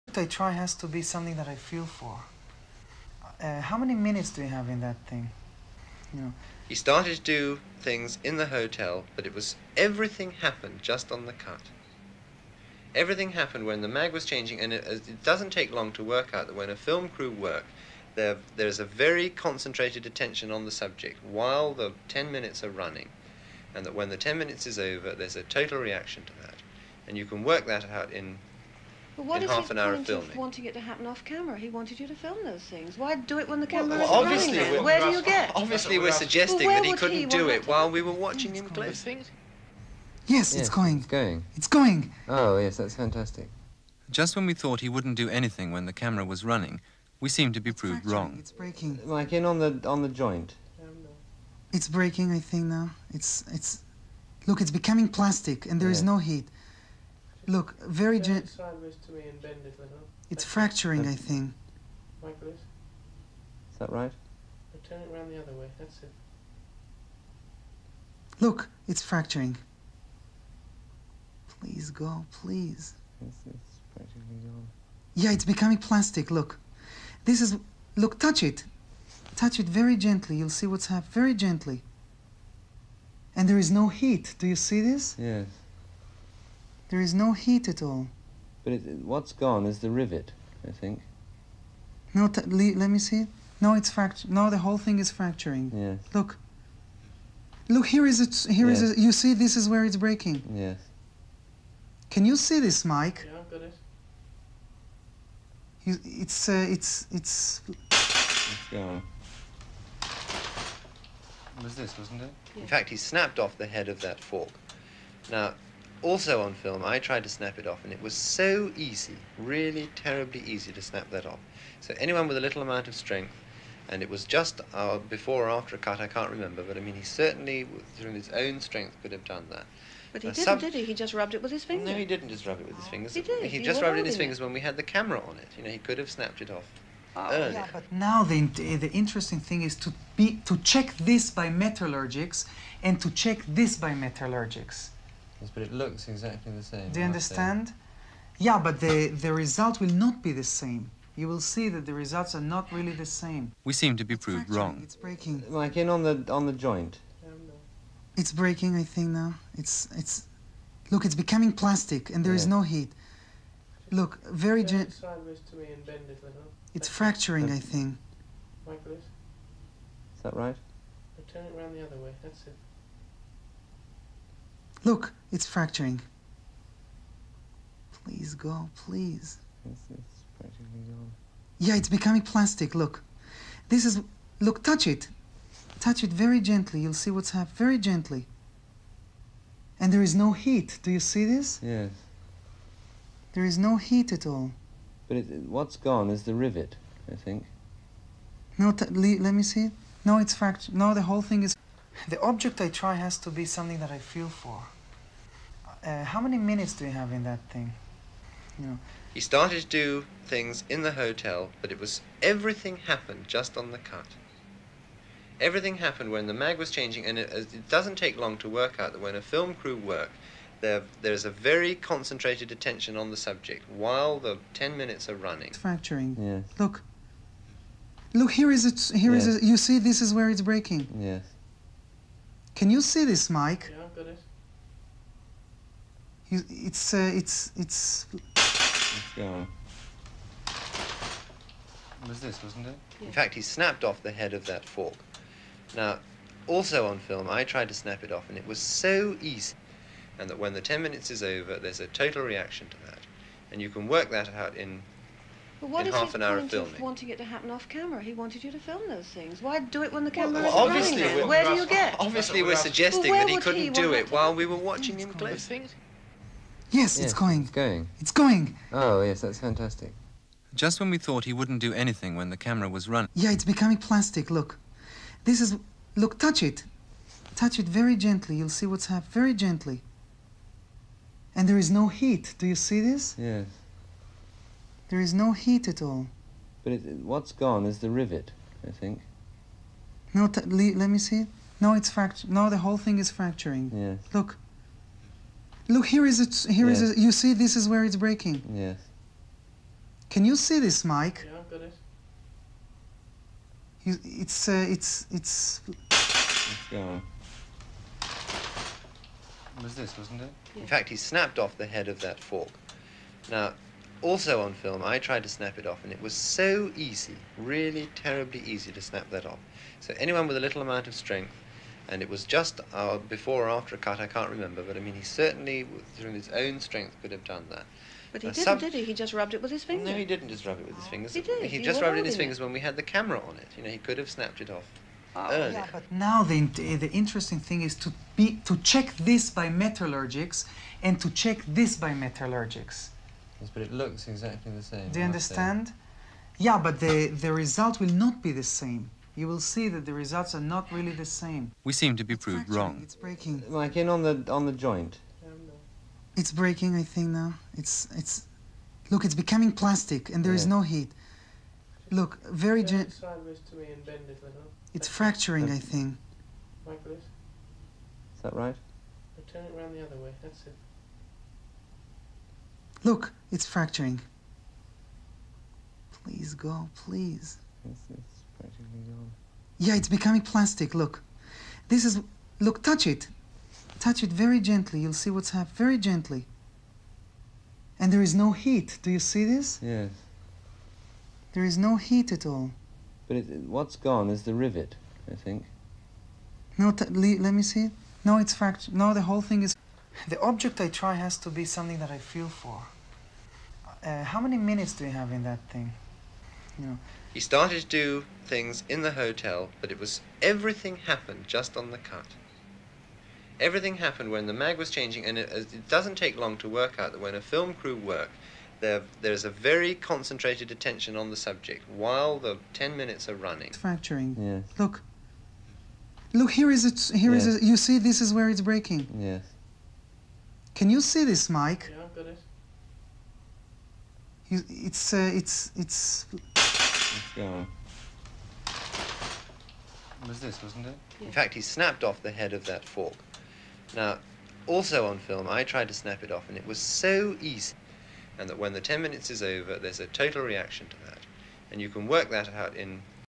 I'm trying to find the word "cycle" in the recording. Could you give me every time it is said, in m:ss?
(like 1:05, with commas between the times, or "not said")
not said.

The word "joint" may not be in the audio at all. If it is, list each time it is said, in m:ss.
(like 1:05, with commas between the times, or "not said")
0:50, 2:36, 5:54.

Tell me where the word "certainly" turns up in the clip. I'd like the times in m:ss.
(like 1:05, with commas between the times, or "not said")
2:07, 5:25.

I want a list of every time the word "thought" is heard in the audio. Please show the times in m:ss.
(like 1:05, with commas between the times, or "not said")
0:44, 4:30.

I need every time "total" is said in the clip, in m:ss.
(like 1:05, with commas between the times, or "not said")
0:25, 4:11, 7:29.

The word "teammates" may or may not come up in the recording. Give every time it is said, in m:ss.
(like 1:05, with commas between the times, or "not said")
not said.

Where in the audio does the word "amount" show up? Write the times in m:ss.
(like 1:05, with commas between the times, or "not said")
2:02, 5:20.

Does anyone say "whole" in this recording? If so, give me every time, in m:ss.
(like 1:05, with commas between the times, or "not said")
1:34, 3:21, 4:52, 6:39.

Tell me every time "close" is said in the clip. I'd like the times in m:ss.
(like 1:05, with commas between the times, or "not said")
0:38, 4:25.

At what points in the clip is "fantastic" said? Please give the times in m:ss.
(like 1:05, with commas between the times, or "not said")
0:42, 4:29.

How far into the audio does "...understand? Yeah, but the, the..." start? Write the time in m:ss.
2:27.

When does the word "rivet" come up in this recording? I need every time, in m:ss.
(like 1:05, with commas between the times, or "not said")
1:29, 3:16, 4:47, 6:34.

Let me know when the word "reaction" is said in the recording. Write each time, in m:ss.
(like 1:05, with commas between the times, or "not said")
0:25, 4:12, 7:30.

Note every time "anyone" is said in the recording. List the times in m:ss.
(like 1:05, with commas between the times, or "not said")
2:01, 5:19.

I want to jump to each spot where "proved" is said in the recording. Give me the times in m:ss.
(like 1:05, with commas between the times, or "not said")
0:47, 2:34, 5:52.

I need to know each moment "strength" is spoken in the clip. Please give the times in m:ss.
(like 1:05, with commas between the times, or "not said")
2:02, 2:08, 5:20, 5:26.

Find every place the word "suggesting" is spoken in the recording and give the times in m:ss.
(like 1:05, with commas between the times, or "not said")
0:36, 4:22.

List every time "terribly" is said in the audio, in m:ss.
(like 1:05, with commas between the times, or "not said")
1:59, 5:17.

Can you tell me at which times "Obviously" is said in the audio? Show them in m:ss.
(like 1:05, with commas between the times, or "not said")
0:35, 4:21.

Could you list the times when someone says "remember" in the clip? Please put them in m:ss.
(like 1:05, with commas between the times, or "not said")
2:06, 5:24.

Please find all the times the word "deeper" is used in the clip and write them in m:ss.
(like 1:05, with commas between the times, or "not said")
not said.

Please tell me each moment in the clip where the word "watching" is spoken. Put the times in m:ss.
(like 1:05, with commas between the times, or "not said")
0:38, 4:24.